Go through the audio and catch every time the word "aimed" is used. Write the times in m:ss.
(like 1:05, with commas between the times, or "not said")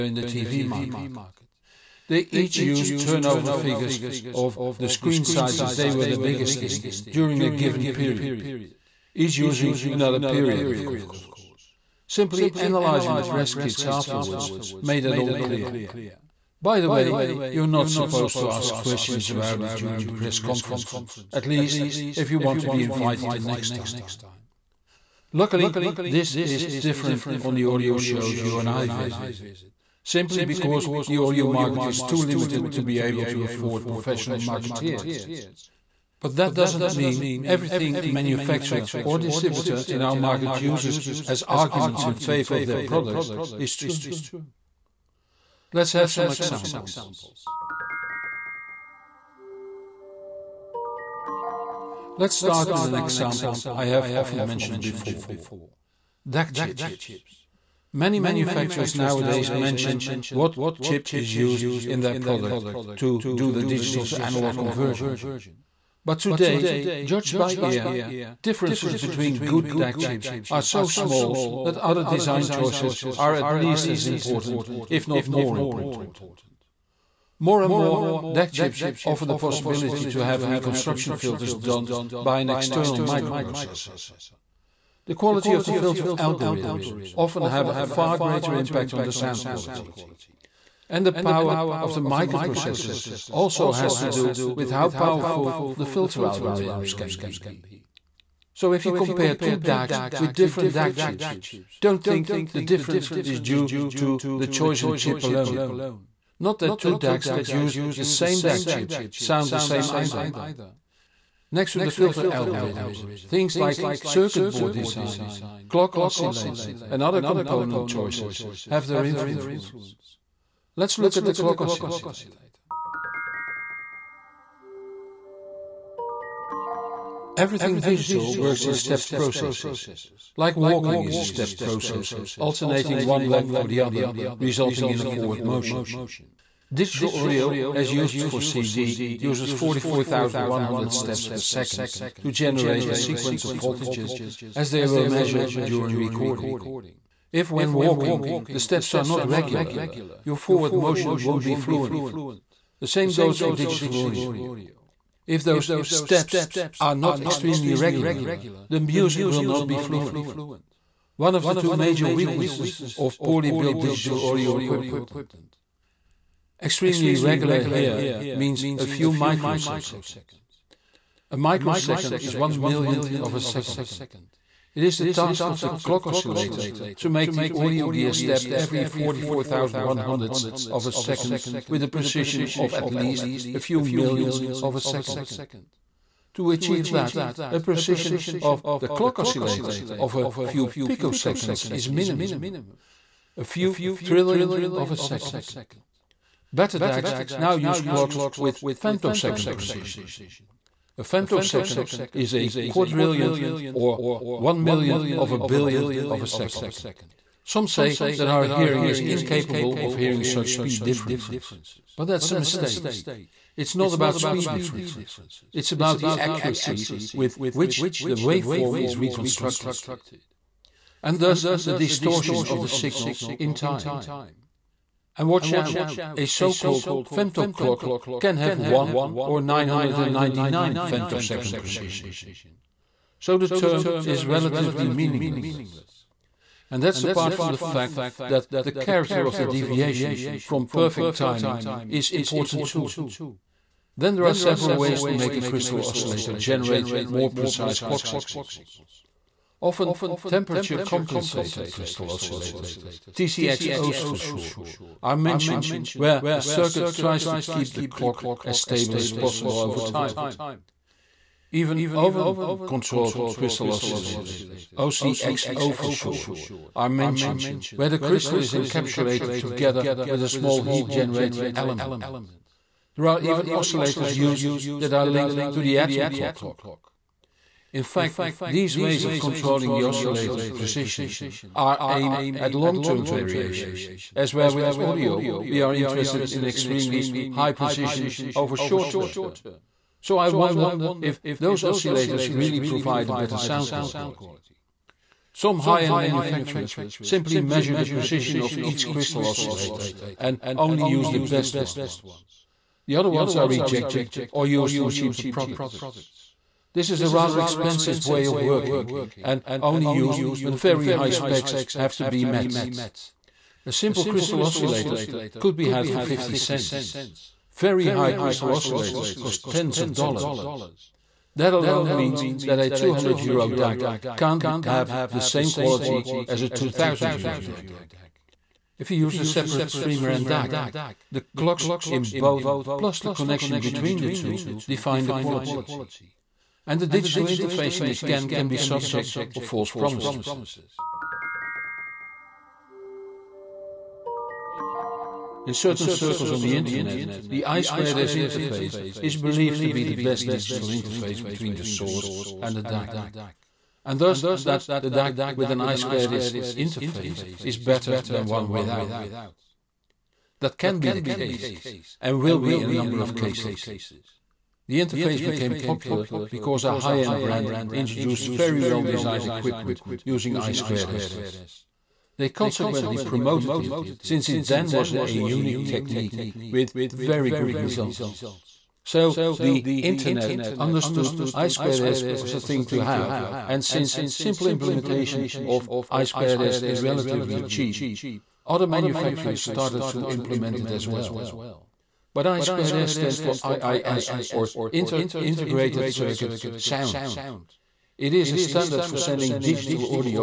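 4:41.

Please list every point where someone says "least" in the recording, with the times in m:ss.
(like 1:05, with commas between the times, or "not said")
0:21, 1:13, 3:02.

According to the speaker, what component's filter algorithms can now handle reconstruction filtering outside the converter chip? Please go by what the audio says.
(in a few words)
external microprocessor.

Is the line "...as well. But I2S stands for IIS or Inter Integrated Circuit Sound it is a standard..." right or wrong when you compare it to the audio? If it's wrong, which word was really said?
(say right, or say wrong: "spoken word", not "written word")
right.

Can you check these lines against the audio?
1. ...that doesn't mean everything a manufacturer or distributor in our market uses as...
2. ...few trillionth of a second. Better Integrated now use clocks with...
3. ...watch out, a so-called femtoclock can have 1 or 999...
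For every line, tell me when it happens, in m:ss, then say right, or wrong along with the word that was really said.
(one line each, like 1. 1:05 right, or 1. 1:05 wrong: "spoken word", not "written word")
1. 0:36 right
2. 3:13 wrong: "DACs", not "Integrated"
3. 3:45 right.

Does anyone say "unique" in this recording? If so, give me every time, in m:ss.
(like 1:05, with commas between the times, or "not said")
6:15.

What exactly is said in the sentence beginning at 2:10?
Like walking is a stepped process, alternating one leg for the other, resulting in a forward motion.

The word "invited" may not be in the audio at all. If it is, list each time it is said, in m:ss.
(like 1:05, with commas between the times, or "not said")
0:22.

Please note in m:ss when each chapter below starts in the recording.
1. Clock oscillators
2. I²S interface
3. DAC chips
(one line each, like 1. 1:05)
1. 2:07
2. 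5:41
3. 0:48.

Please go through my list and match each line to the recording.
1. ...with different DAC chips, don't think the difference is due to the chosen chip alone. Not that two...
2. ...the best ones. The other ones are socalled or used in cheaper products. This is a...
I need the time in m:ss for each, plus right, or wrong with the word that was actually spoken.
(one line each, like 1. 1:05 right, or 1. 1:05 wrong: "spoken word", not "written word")
1. 1:40 right
2. 5:01 wrong: "rejected", not "socalled".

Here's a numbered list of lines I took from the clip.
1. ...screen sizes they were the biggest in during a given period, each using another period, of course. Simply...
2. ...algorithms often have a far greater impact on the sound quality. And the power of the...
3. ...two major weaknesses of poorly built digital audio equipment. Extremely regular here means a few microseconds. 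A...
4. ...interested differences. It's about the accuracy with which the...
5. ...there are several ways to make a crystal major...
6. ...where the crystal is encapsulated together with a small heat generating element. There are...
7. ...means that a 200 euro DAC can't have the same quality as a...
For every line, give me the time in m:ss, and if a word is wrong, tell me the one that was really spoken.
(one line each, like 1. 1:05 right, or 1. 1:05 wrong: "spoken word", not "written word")
1. 0:04 right
2. 1:26 right
3. 2:41 right
4. 3:34 wrong: "speed", not "interested"
5. 4:04 wrong: "oscillator", not "major"
6. 4:27 right
7. 5:21 right.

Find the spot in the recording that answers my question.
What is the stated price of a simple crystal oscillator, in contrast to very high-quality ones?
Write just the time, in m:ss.
5:16.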